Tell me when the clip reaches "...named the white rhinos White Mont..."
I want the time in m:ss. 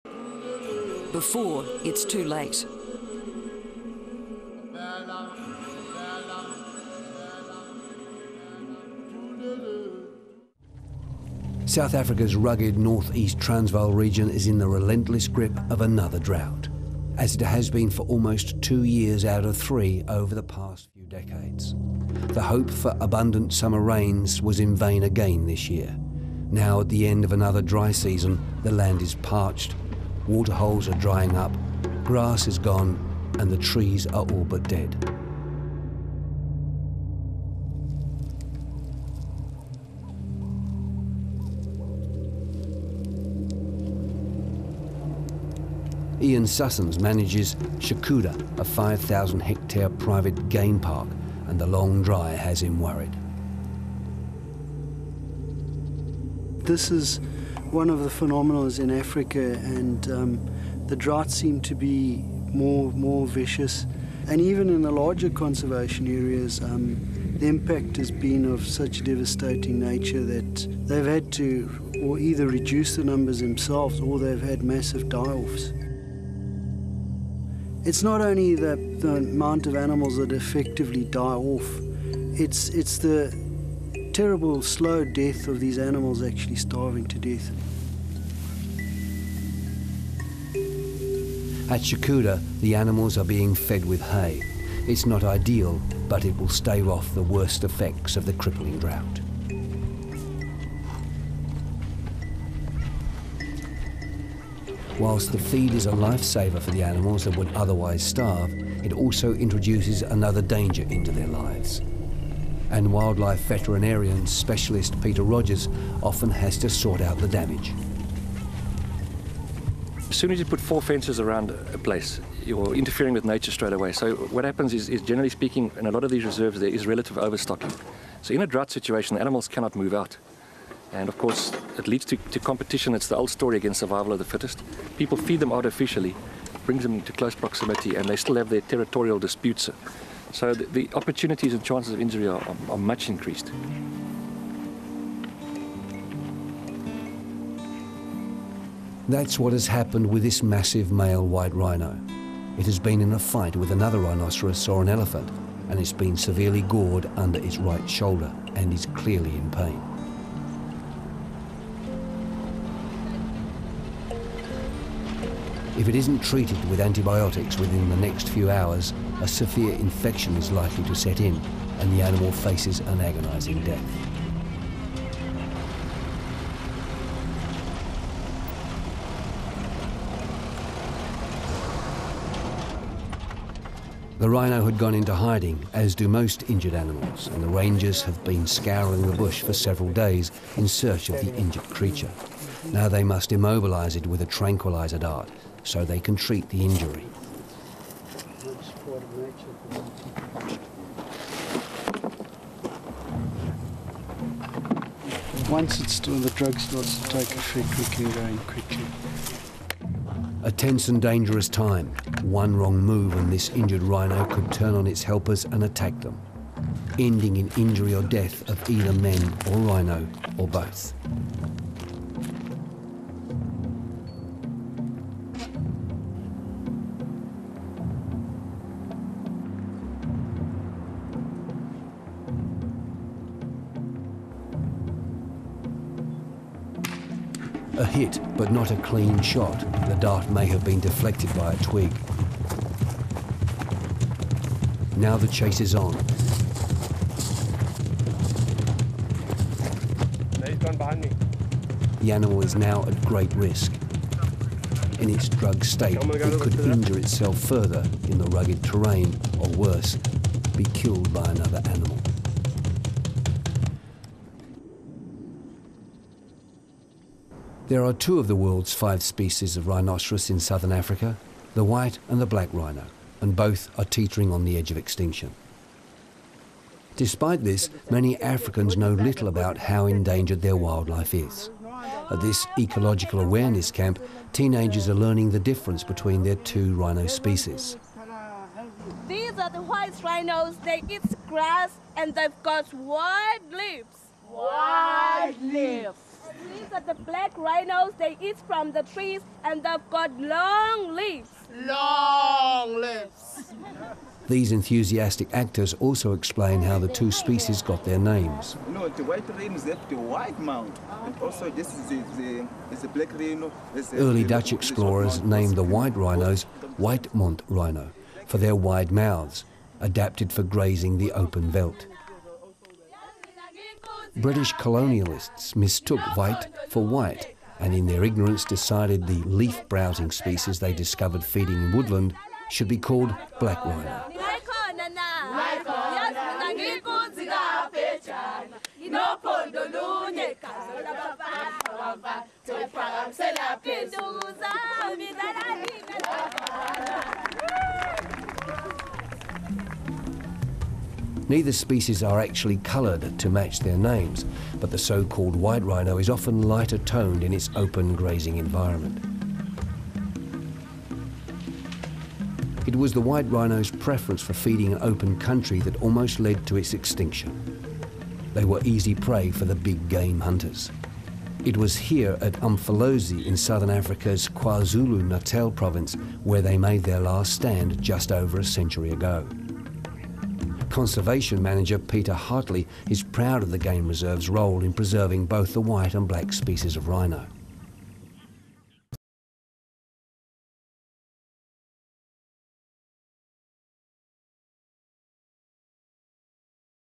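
5:15.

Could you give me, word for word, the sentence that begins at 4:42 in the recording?
At this ecological awareness camp, teenagers are learning the difference between their two rhino species.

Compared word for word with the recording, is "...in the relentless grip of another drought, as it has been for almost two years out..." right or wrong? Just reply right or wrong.
right.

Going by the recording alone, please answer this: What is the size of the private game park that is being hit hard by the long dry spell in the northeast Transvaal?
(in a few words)
5,000 hectares.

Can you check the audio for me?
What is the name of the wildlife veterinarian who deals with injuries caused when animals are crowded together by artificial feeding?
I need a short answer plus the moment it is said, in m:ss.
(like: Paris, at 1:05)
Peter Rogers, at 1:55.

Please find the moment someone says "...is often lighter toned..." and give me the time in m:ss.
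5:55.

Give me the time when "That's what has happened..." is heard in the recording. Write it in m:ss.
2:29.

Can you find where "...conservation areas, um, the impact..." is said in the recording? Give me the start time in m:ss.
1:05.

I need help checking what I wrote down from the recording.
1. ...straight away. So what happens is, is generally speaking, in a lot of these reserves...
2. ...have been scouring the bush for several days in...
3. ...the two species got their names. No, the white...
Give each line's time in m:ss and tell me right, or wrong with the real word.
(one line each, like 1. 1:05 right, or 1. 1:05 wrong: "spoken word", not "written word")
1. 2:03 right
2. 3:08 right
3. 5:06 right.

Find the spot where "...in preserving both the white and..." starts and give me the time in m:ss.
6:24.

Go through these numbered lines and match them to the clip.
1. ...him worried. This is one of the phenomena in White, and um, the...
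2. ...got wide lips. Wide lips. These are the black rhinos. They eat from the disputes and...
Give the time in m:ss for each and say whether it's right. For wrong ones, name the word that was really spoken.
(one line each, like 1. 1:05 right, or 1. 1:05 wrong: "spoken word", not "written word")
1. 0:52 wrong: "Africa", not "White"
2. 4:52 wrong: "trees", not "disputes".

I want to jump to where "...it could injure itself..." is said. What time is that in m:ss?
4:16.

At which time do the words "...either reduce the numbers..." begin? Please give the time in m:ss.
1:12.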